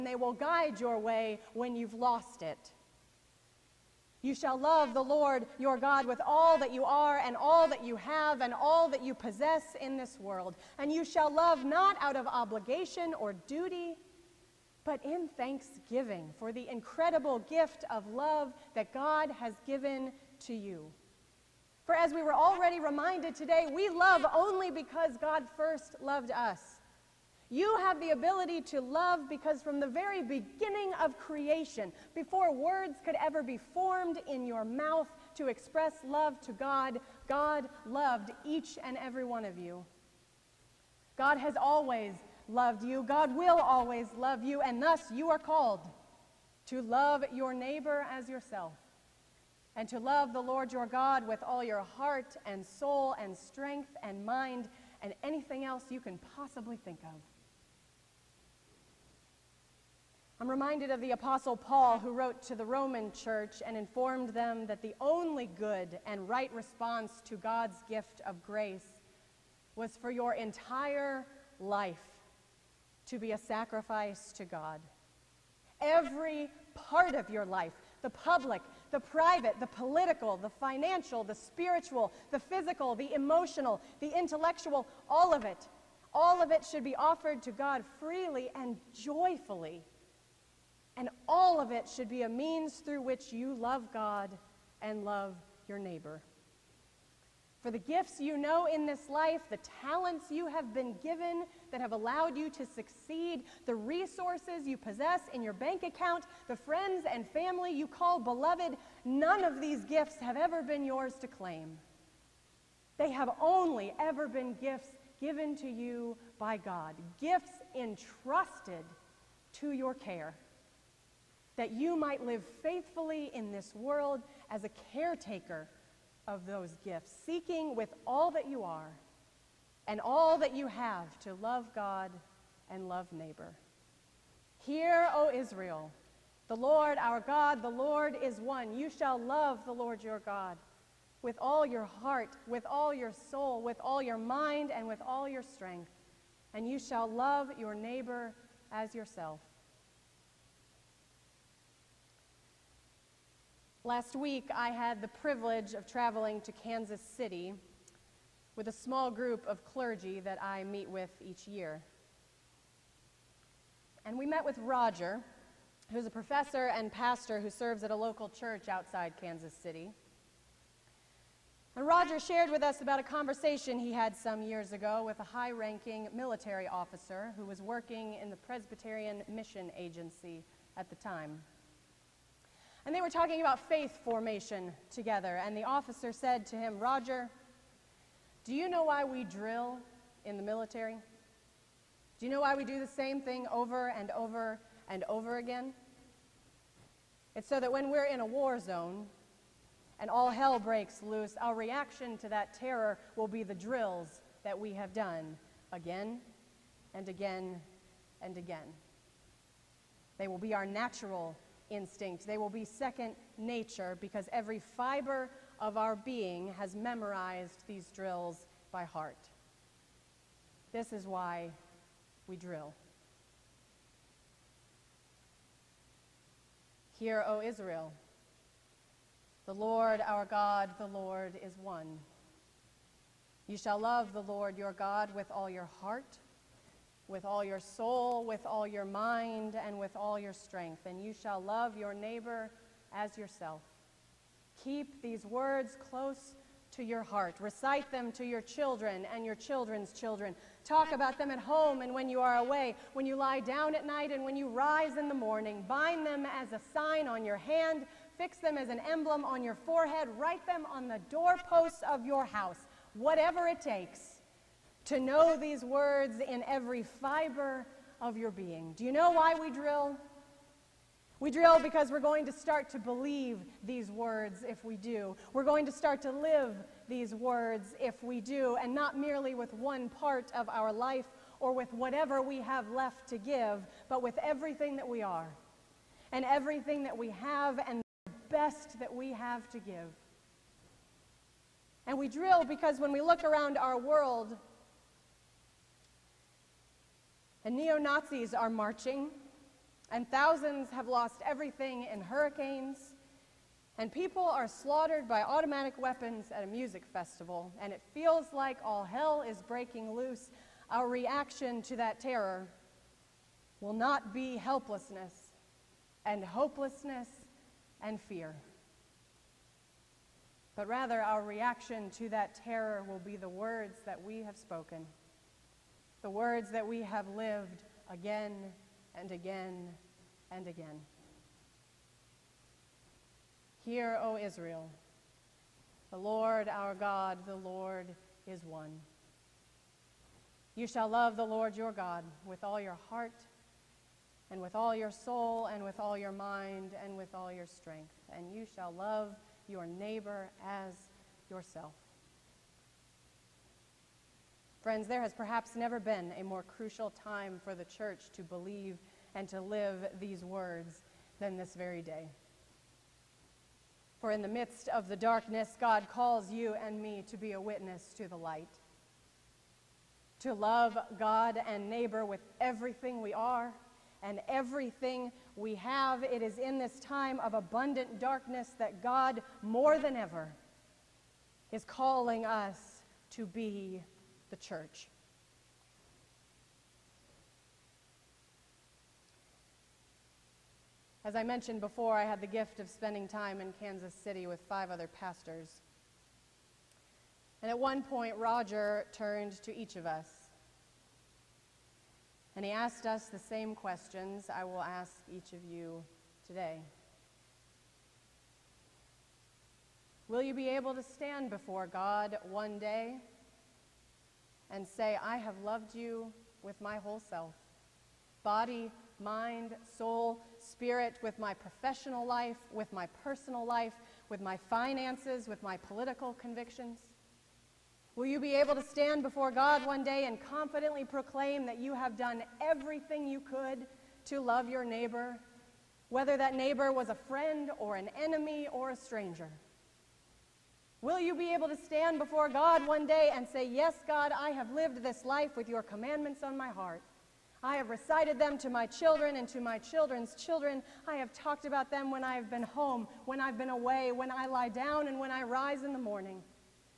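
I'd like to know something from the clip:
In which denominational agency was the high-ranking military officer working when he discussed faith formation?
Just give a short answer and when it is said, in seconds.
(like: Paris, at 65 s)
Presbyterian Mission Agency, at 178 s.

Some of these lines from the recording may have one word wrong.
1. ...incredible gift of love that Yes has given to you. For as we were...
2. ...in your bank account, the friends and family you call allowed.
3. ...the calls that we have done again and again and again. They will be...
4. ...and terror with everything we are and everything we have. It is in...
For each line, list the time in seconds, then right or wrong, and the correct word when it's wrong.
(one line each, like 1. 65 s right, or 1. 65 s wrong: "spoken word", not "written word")
1. 16 s wrong: "God", not "Yes"
2. 105 s wrong: "beloved", not "allowed"
3. 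203 s wrong: "drills", not "calls"
4. 371 s wrong: "neighbor", not "terror".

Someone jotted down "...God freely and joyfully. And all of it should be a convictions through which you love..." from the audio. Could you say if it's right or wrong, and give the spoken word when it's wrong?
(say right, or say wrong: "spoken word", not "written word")
wrong: "means", not "convictions".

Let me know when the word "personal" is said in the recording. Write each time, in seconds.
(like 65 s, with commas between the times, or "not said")
423 s.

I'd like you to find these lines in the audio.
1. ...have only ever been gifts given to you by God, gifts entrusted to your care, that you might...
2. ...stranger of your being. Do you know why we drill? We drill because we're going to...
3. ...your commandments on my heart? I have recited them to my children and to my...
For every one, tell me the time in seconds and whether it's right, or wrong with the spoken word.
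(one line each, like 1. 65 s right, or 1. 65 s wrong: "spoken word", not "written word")
1. 113 s right
2. 266 s wrong: "fiber", not "stranger"
3. 445 s right.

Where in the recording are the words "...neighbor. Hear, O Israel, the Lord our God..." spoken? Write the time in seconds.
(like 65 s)
133 s.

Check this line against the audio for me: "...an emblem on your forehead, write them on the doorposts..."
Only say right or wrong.
right.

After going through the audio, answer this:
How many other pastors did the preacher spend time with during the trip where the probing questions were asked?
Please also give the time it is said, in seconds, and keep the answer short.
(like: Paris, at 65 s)
5, at 394 s.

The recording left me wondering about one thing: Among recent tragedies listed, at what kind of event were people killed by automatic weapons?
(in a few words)
A music festival.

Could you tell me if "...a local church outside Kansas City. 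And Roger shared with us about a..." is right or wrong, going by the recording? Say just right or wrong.
right.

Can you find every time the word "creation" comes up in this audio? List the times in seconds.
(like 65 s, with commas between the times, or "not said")
31 s.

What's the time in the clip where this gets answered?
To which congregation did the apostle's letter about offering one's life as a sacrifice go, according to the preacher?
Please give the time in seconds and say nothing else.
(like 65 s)
62 s.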